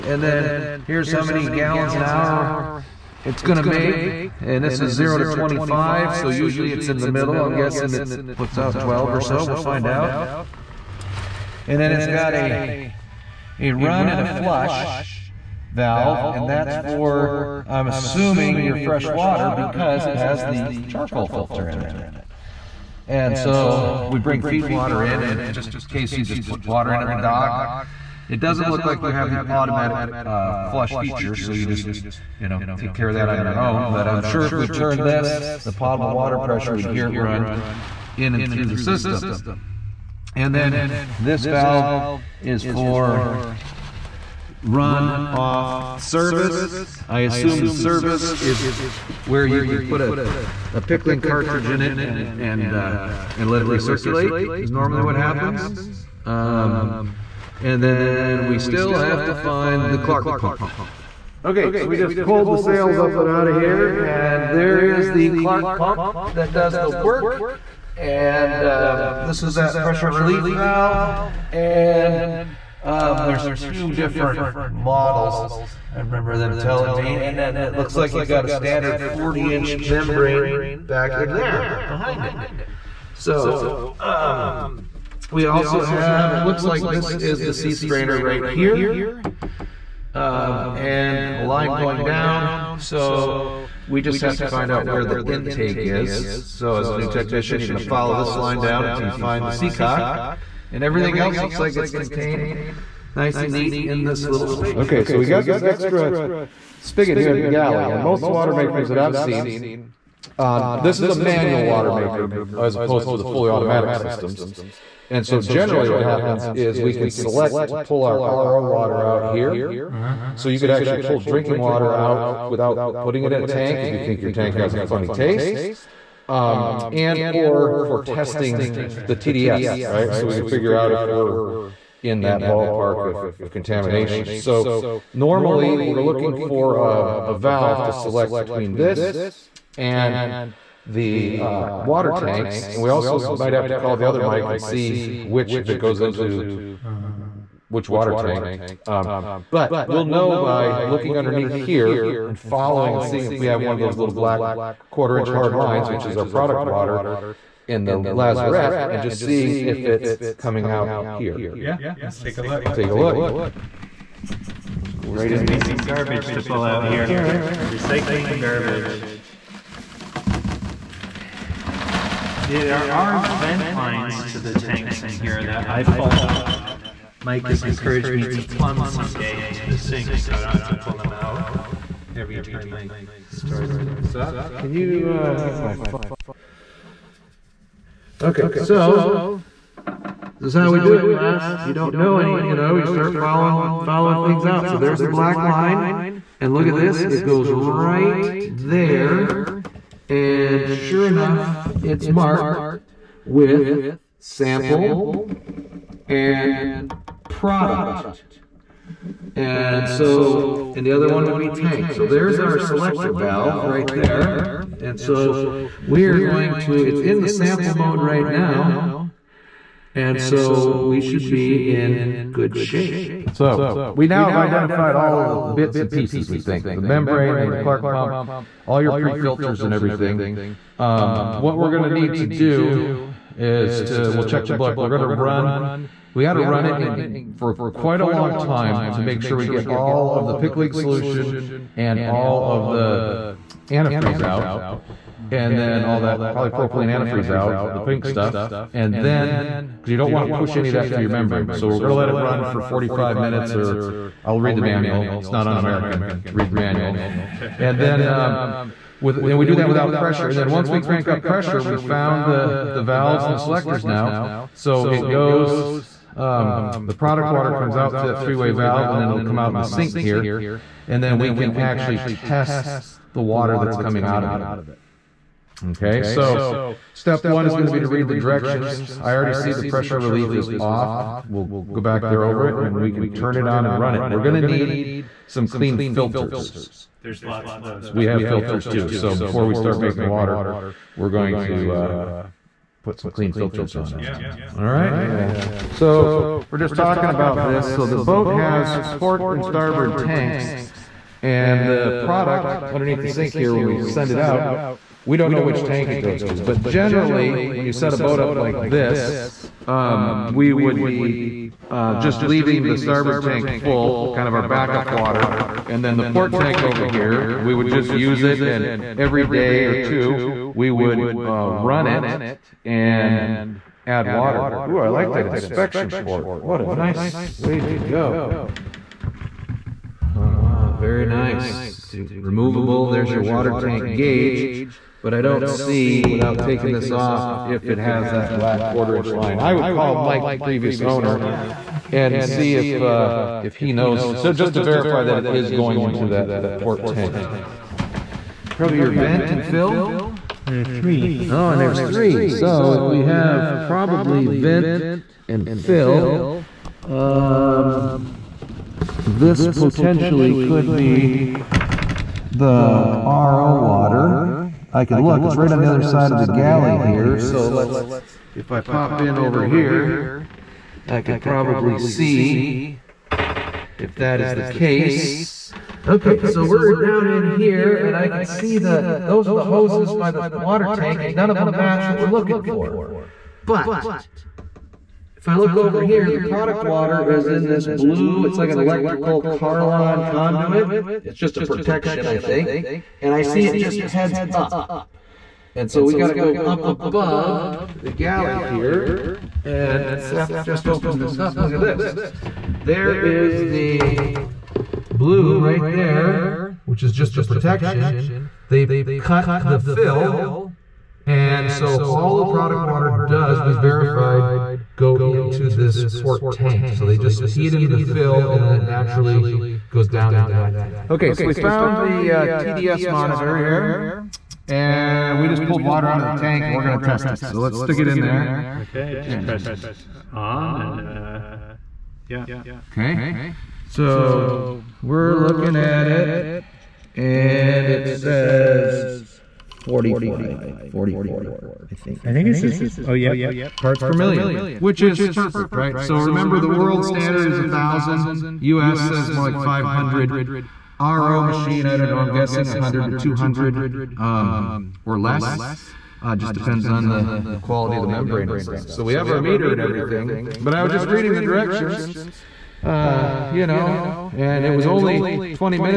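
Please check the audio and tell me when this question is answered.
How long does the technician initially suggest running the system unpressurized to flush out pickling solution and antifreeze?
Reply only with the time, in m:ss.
4:12.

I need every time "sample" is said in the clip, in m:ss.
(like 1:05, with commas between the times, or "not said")
3:24, 3:37.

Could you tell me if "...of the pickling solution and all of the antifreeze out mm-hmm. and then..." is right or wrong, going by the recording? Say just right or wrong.
right.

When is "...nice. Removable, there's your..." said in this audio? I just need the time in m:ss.
5:31.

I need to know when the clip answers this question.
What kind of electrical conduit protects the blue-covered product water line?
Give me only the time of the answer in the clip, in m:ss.
6:29.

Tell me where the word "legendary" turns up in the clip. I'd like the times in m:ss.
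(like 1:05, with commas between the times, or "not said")
not said.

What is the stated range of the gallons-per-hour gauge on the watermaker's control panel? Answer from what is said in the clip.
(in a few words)
0 to 25.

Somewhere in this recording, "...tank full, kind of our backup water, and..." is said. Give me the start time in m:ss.
5:13.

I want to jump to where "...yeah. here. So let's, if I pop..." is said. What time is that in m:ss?
6:06.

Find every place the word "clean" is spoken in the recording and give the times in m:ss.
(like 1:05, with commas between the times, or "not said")
4:45, 4:53.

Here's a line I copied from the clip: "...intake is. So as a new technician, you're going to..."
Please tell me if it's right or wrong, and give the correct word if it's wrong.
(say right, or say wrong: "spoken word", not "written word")
right.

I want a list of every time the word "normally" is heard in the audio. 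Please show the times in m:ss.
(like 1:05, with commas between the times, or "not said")
0:54, 2:15.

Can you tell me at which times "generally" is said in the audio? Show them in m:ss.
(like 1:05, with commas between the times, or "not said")
1:55, 5:06.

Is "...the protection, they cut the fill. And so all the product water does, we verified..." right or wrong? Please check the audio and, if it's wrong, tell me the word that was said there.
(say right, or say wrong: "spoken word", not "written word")
right.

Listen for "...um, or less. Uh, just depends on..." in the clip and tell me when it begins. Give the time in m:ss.
7:33.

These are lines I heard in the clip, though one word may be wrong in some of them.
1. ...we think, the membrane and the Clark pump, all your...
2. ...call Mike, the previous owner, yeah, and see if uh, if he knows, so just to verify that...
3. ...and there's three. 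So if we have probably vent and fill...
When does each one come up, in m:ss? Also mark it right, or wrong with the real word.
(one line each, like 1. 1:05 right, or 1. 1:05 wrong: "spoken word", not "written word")
1. 3:46 right
2. 5:39 right
3. 5:51 right.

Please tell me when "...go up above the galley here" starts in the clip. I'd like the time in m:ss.
6:36.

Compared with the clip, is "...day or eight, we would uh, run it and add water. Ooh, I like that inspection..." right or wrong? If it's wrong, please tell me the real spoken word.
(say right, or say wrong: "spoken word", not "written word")
wrong: "two", not "eight".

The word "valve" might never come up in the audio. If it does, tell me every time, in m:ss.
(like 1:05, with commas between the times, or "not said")
0:15, 0:41, 1:10, 2:17, 3:33, 4:22, 4:28.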